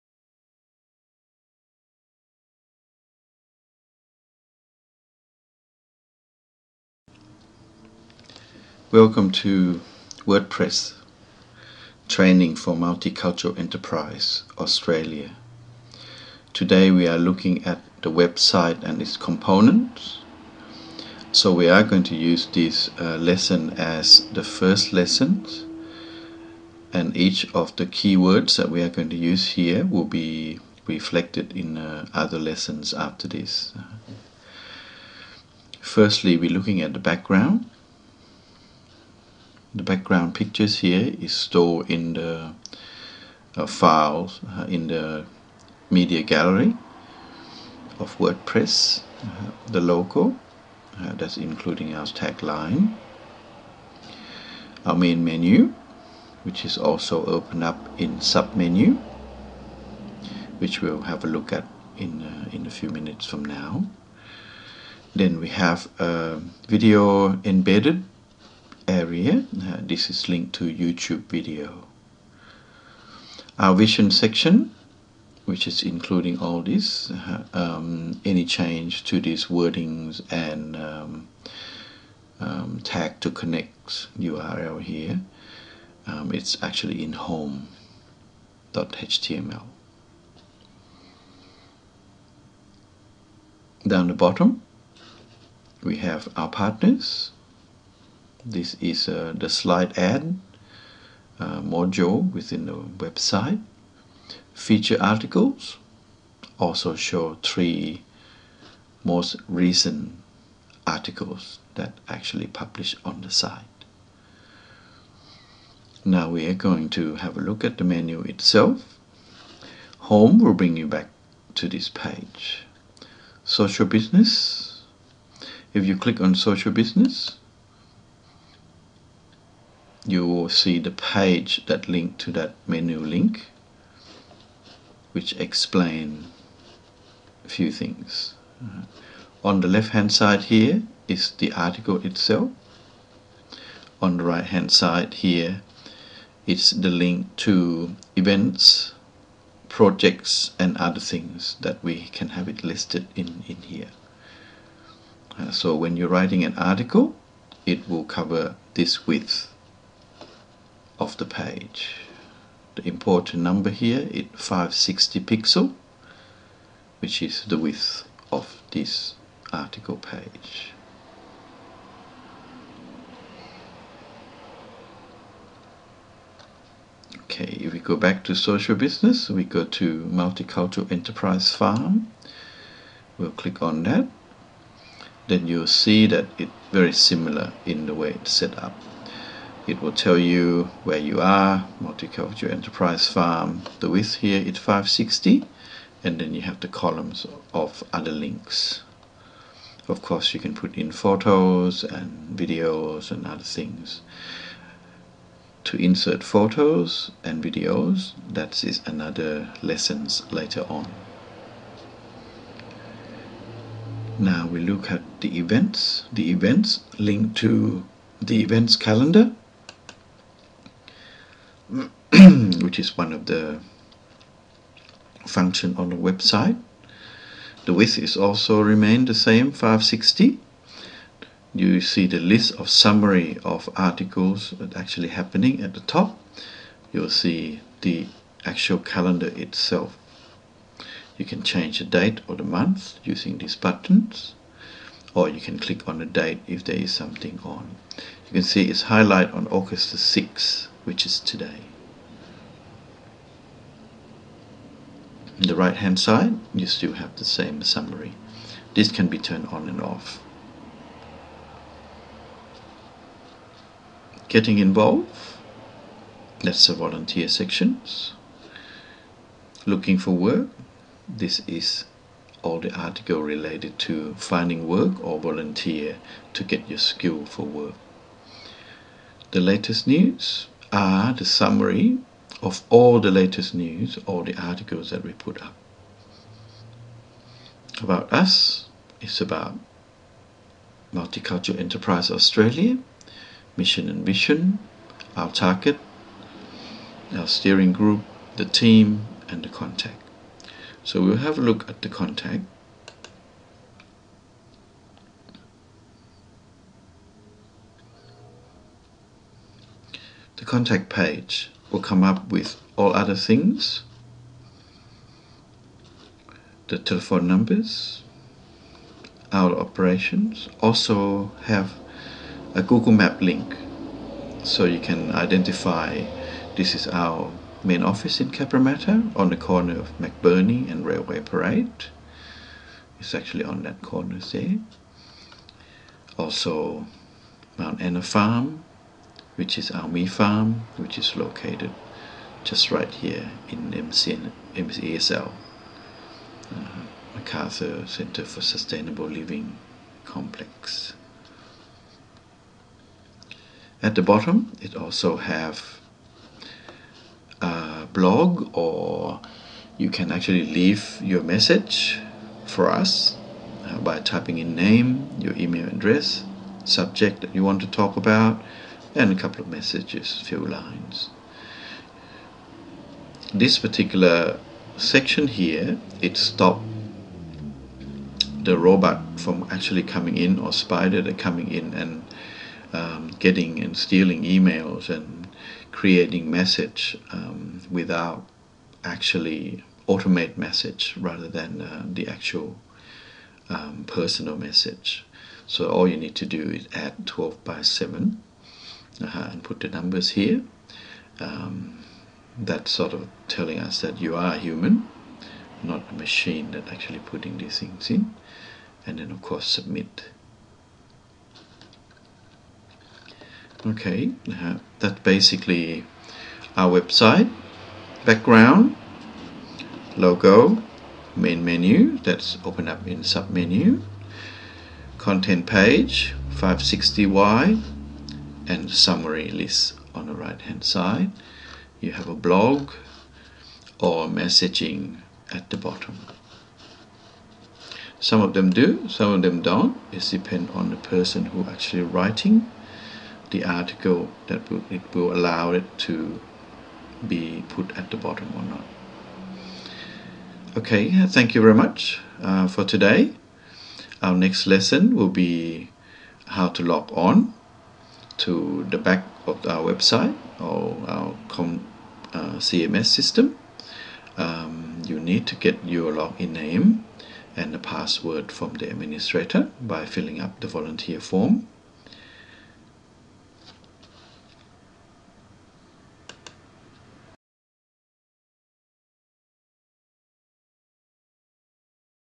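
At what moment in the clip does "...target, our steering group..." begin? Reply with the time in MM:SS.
04:55.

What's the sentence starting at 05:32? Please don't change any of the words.
It's actually on that corner there.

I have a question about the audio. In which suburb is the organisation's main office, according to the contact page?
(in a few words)
Cabramatta.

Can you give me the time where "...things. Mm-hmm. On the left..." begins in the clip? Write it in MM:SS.
02:17.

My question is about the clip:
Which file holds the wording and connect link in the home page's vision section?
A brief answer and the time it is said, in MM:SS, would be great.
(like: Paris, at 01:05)
home.html, at 01:27.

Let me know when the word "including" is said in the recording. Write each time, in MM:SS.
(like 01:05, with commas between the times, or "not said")
00:51, 01:15.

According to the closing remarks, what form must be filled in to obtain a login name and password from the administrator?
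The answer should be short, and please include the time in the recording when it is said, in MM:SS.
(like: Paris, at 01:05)
volunteer form, at 07:50.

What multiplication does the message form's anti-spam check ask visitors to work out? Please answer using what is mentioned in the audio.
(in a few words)
12 by 7.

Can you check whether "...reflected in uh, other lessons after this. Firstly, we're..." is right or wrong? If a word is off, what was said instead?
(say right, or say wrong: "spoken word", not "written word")
right.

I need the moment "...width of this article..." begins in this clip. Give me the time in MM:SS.
02:47.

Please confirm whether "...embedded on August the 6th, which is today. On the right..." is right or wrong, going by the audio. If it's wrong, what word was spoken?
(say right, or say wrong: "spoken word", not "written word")
wrong: "highlighted", not "embedded".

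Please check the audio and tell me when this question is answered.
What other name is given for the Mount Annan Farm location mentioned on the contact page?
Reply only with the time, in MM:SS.
05:39.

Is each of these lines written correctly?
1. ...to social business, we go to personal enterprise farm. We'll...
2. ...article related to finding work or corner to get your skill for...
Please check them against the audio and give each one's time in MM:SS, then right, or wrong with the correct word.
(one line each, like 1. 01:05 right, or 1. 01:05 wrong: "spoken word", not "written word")
1. 02:58 wrong: "multicultural", not "personal"
2. 04:32 wrong: "volunteer", not "corner".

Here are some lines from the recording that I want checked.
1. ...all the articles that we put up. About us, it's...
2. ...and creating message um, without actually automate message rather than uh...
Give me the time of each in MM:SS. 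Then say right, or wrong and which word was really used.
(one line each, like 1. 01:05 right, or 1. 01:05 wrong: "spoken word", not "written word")
1. 04:44 right
2. 06:24 right.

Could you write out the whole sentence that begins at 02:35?
Uh, so when you're writing an article, it will cover this width of the page.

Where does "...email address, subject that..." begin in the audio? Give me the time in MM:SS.
06:05.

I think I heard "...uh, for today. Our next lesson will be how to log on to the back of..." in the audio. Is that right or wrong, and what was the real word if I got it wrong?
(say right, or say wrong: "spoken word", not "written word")
right.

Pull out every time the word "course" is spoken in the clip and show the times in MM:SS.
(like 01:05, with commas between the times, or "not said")
03:20, 06:49.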